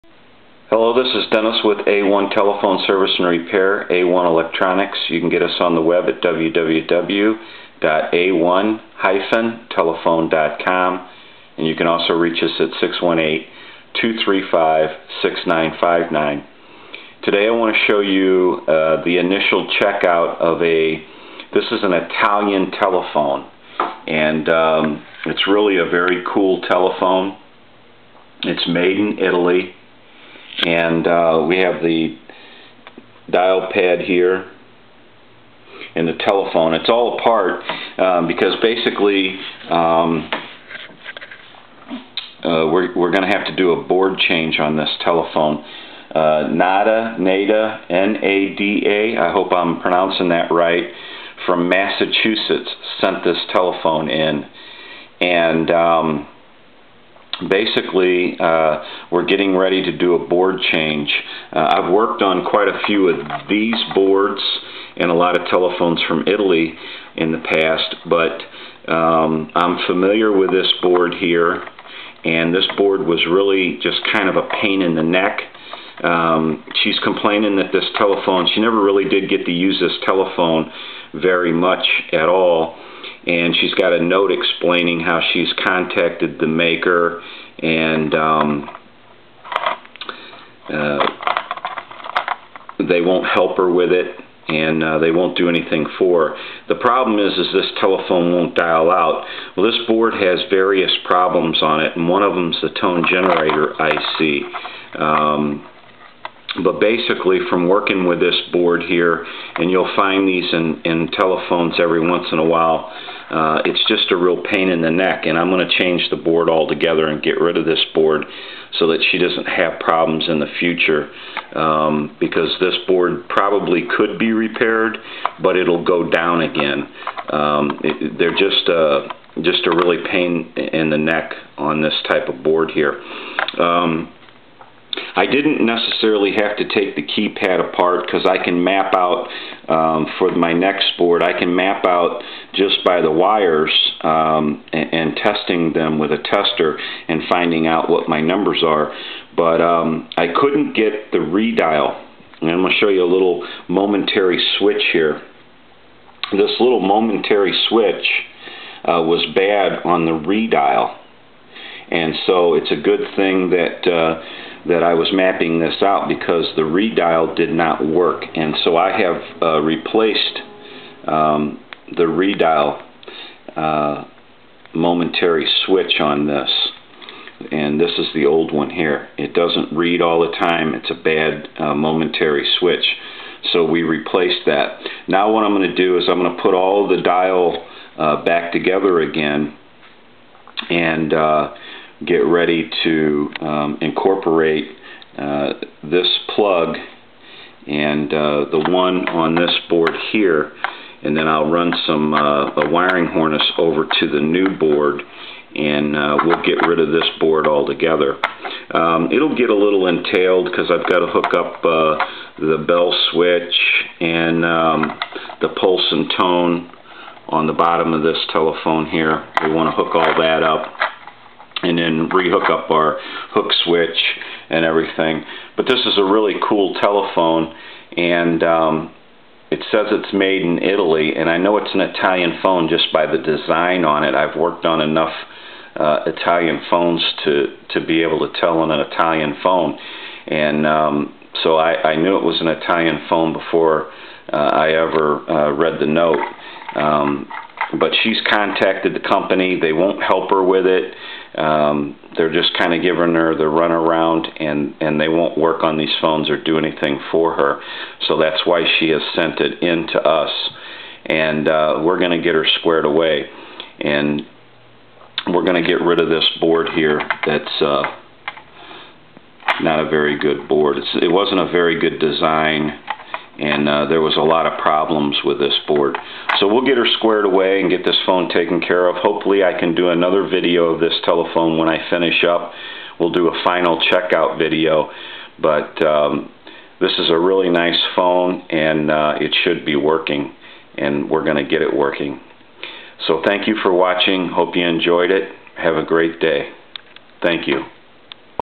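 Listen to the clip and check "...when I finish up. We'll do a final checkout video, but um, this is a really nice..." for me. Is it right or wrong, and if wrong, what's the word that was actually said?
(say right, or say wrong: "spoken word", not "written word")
right.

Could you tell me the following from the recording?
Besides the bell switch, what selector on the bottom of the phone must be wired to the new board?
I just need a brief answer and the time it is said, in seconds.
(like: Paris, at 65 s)
Pulse and tone, at 215 s.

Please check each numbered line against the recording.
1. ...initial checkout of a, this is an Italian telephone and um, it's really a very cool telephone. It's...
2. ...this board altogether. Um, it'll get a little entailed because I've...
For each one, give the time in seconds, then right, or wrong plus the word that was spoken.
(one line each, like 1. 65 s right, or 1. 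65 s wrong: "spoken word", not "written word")
1. 19 s right
2. 206 s right.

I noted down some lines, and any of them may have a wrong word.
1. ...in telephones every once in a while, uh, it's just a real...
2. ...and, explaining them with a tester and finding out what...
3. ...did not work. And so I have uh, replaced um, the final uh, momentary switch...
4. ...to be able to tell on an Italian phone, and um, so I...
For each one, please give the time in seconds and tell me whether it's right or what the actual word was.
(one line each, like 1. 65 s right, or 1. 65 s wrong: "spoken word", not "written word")
1. 110 s right
2. 144 s wrong: "testing", not "explaining"
3. 167 s wrong: "redial", not "final"
4. 237 s right.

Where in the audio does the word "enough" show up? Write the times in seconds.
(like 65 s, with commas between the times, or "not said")
234 s.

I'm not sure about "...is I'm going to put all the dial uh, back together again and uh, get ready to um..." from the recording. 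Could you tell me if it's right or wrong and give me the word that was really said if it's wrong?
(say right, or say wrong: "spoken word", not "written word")
right.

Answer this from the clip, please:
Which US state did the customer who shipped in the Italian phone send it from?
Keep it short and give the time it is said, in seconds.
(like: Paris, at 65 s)
Massachusetts, at 51 s.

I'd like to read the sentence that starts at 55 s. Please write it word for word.
And um, basically uh, we're getting ready to do a board change.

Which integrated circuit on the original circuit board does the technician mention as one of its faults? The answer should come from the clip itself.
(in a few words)
Tone generator IC.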